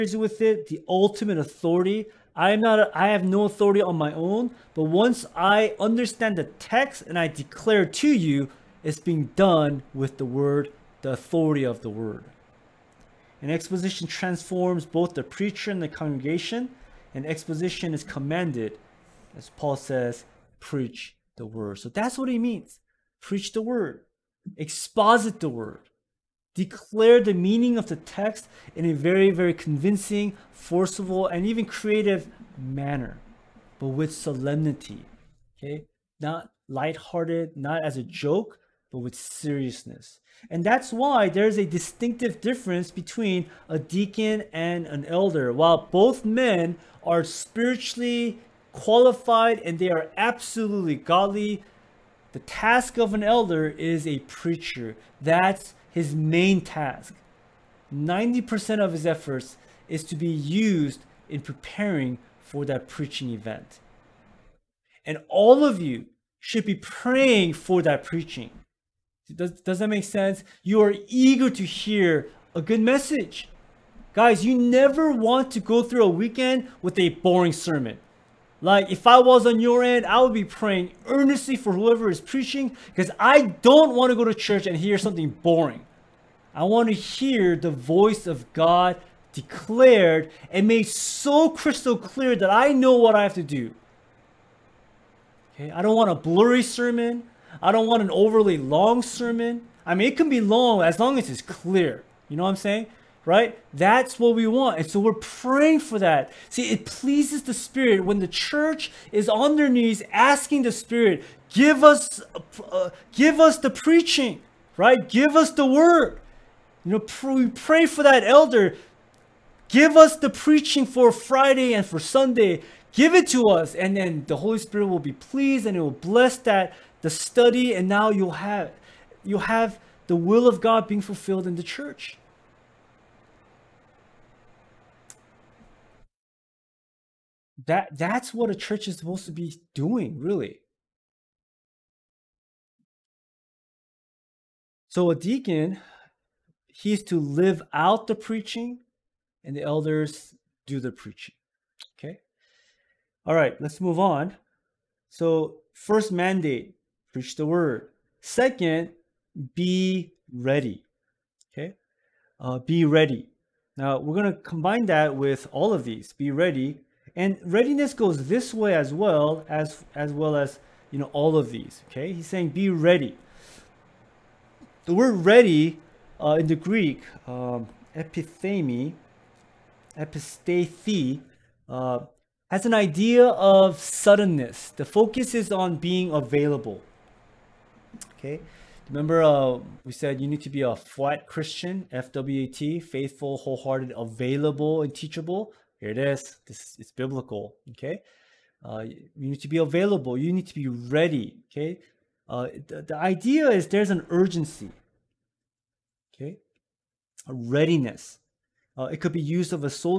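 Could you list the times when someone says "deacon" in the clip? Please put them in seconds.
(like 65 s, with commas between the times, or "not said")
43 s, 145 s.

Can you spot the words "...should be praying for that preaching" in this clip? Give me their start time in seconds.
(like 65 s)
66 s.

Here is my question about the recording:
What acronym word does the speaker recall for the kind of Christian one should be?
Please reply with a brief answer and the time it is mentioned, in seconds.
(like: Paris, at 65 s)
Flat, at 190 s.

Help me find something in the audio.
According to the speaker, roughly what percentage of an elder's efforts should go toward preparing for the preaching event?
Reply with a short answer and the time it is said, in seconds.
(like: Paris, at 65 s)
90%, at 57 s.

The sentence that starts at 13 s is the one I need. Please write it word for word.
And exposition transforms both the preacher and the congregation, and exposition is commanded, as Paul says, preach the word.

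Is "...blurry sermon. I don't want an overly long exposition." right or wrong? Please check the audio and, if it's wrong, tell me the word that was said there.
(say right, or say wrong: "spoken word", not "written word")
wrong: "sermon", not "exposition".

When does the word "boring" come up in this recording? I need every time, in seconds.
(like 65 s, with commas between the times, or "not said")
77 s, 85 s.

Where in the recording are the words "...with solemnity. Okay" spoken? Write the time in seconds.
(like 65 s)
33 s.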